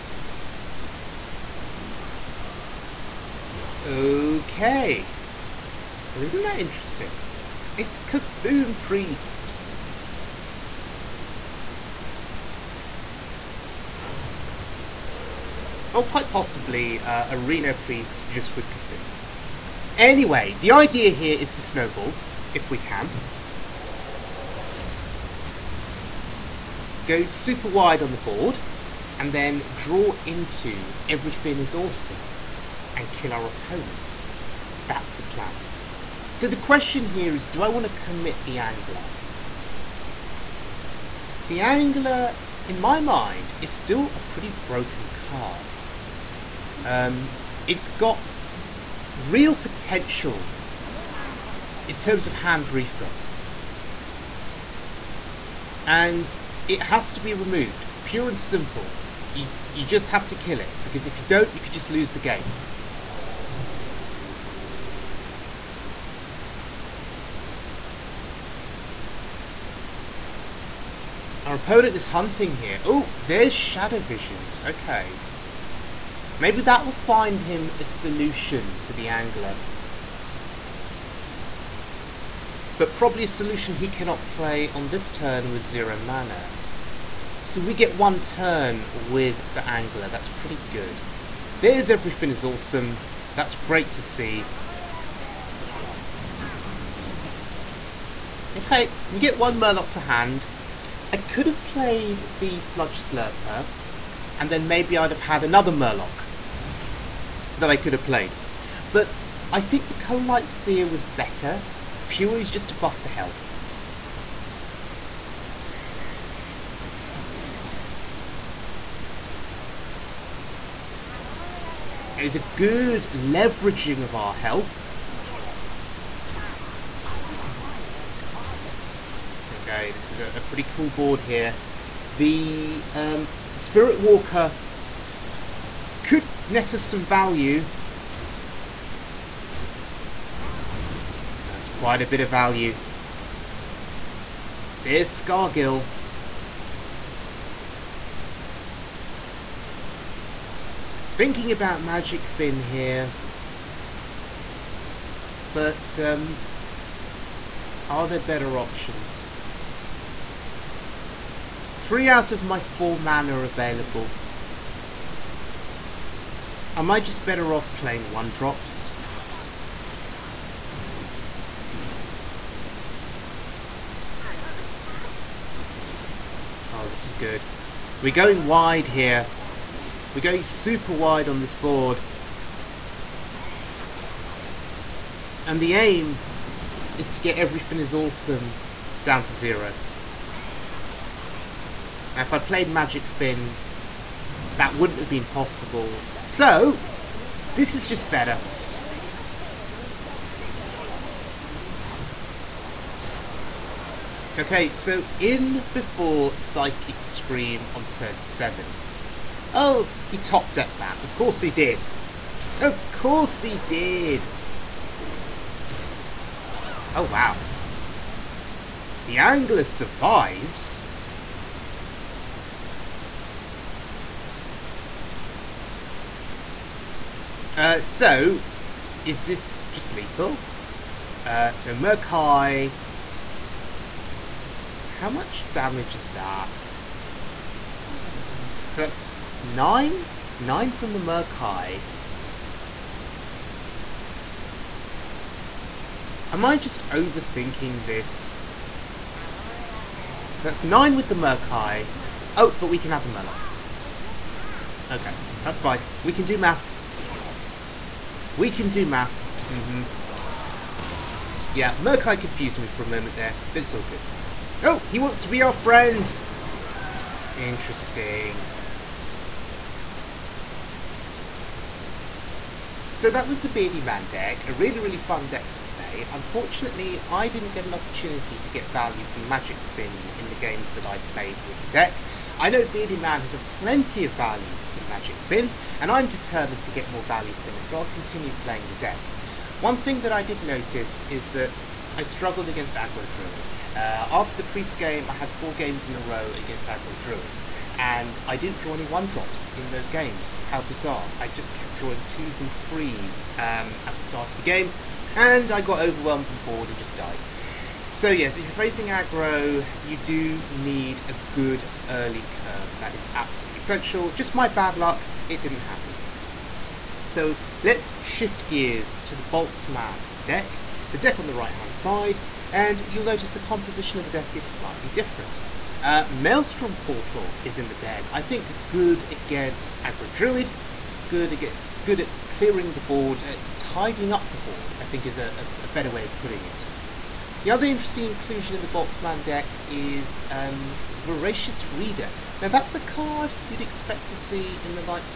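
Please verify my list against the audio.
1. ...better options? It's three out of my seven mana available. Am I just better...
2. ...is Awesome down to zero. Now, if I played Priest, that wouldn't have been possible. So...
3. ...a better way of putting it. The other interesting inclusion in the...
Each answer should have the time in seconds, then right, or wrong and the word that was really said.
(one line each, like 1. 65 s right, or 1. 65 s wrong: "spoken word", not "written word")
1. 158 s wrong: "four", not "seven"
2. 187 s wrong: "Magicfin", not "Priest"
3. 335 s right.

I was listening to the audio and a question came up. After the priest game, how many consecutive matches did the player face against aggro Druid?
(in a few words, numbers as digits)
4.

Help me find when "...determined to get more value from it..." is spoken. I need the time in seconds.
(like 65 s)
286 s.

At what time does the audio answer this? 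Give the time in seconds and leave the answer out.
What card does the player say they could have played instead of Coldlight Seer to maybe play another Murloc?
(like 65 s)
102 s.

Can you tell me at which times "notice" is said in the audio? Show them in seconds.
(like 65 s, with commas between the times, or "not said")
290 s, 323 s.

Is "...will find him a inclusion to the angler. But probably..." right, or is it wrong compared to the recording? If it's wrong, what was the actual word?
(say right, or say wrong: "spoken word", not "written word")
wrong: "solution", not "inclusion".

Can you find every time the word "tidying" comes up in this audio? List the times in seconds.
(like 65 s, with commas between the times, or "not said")
333 s.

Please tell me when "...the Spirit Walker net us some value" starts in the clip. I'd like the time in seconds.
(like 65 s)
133 s.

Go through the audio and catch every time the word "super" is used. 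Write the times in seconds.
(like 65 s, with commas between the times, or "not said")
27 s, 180 s.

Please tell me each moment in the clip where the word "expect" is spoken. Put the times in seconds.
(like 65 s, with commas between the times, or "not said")
343 s.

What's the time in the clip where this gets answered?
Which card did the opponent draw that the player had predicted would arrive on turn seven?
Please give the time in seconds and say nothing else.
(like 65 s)
206 s.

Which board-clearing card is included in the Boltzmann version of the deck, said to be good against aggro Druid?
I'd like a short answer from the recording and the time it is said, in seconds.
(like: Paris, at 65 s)
Maelstrom Portal, at 326 s.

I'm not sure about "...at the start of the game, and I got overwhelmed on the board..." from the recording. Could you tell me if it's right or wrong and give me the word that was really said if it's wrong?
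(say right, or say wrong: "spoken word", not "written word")
right.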